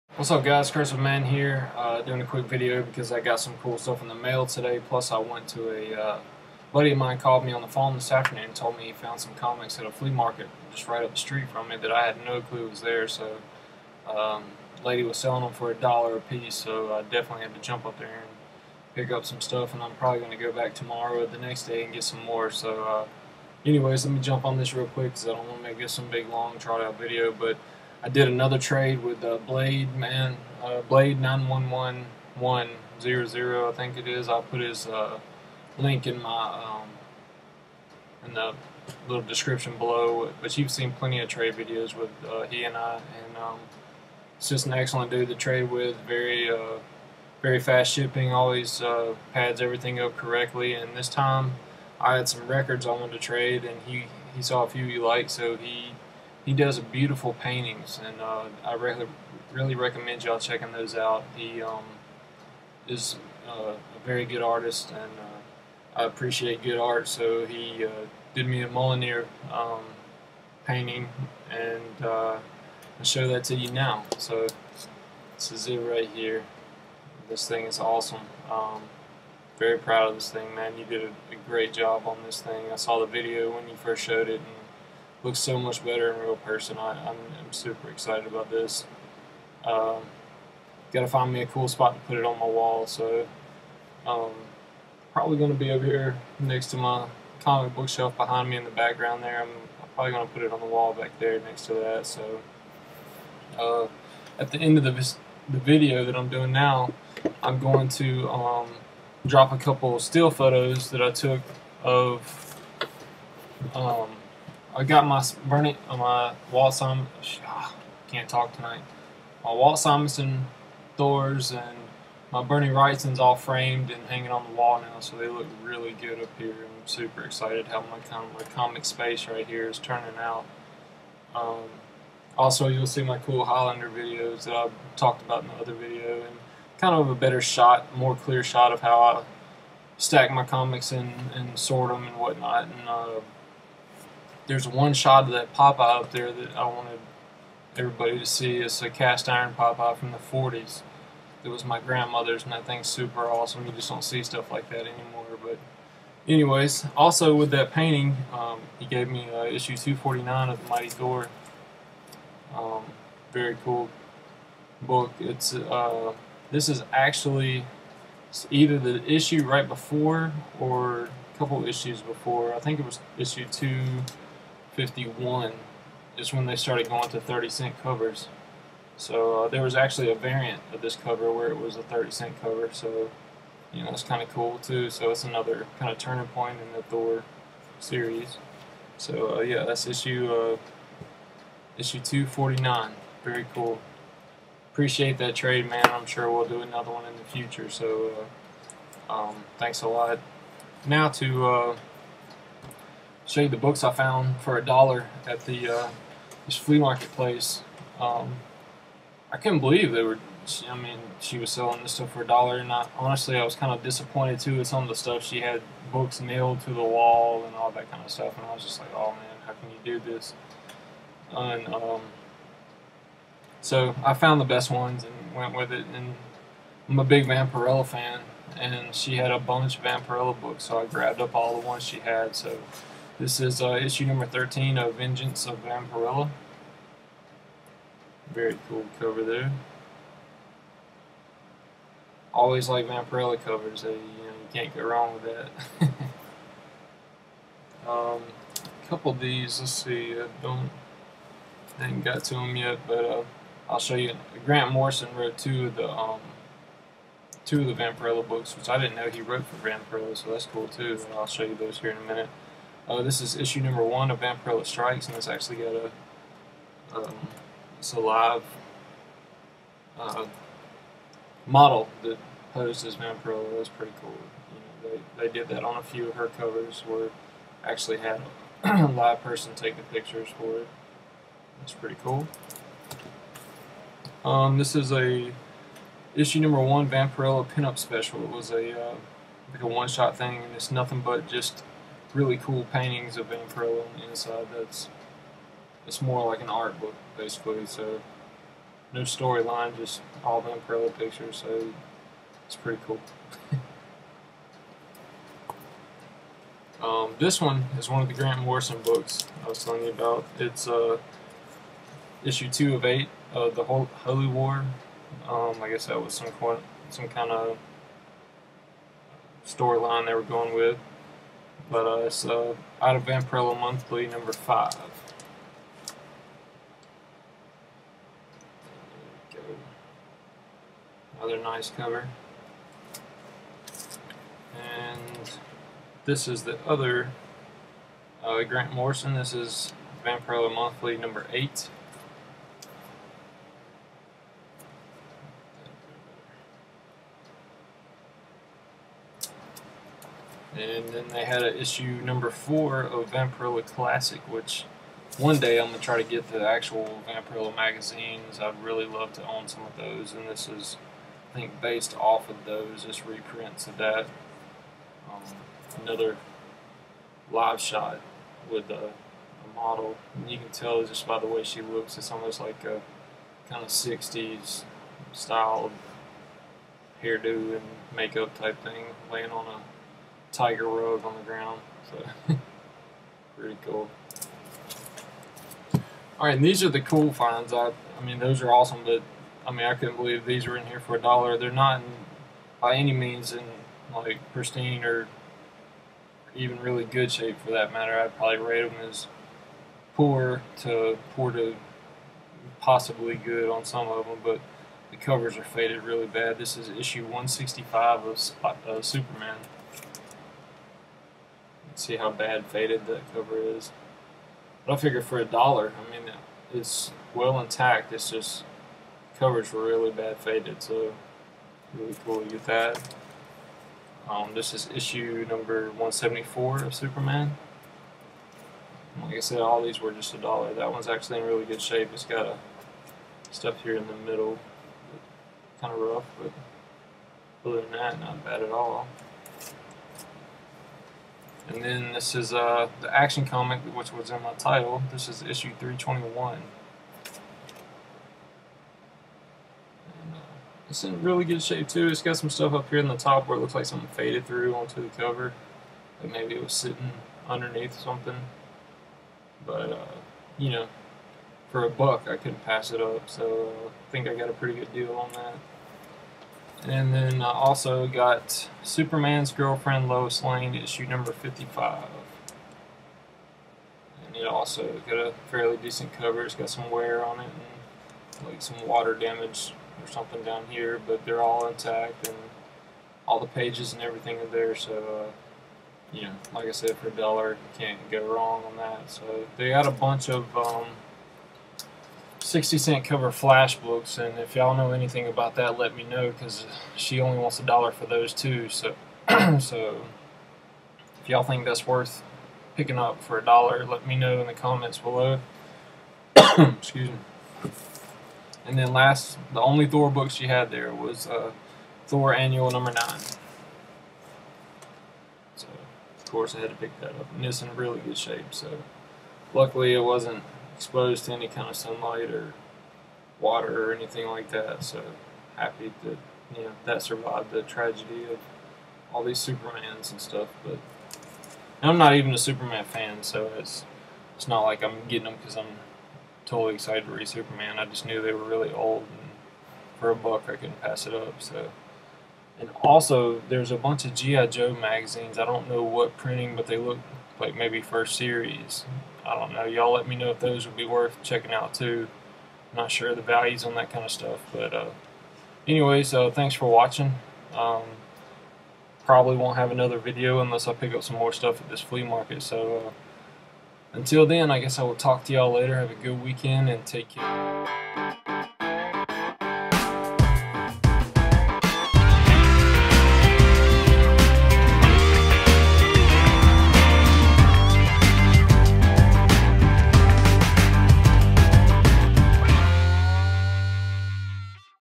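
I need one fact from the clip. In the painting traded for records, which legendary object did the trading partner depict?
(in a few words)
Mjolnir.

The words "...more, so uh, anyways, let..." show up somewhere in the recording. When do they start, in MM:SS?
00:22.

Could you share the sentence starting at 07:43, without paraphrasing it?
So uh, I think I got a pretty good deal on that.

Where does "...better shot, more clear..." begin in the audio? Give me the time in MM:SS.
02:17.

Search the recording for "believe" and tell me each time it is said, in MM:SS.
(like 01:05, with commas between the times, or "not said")
03:29, 06:29.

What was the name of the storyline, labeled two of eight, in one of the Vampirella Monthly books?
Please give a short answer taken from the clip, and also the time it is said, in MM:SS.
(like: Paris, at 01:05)
Holy War, at 05:13.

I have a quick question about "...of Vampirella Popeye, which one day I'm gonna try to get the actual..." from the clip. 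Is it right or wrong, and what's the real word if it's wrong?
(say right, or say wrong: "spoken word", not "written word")
wrong: "Classic", not "Popeye".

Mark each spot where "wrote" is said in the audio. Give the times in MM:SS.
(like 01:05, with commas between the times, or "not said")
04:15, 04:19.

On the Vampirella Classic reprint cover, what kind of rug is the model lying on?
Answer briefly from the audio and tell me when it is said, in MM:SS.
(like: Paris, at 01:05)
tiger rug, at 06:20.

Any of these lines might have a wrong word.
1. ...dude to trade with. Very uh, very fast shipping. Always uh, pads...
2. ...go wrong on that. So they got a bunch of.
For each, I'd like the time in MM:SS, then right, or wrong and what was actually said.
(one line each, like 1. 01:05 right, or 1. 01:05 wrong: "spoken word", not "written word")
1. 00:45 right
2. 08:07 right.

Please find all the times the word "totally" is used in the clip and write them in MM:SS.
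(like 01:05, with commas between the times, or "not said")
08:56.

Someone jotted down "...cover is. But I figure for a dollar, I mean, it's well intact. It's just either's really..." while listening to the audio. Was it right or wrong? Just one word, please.
wrong.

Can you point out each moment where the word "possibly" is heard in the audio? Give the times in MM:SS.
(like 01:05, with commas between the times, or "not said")
06:42.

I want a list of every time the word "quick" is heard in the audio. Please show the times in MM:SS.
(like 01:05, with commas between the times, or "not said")
00:02, 00:24.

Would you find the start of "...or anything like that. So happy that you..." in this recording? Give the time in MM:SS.
08:43.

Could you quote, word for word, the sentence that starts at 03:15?
I'm sure we'll do another one in the future.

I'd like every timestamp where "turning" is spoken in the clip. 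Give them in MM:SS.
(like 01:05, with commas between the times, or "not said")
02:09, 03:05.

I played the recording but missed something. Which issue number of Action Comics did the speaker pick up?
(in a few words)
321.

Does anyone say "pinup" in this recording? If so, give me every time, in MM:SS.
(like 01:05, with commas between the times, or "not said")
04:47.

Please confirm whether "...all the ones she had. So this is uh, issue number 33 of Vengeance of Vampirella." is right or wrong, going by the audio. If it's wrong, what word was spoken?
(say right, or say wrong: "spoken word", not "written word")
wrong: "13", not "33".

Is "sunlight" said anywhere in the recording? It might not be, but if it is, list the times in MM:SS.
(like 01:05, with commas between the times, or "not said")
08:41.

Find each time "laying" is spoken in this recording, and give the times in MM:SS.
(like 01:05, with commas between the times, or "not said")
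06:19.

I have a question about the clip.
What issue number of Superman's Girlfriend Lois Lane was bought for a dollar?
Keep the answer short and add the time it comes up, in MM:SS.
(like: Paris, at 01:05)
55, at 07:51.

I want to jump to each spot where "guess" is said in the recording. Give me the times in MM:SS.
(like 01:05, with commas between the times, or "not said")
05:15, 09:24.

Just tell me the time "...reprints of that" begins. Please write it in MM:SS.
06:03.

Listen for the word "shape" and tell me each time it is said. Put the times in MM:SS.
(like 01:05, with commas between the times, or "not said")
06:37, 07:11, 07:31, 08:37.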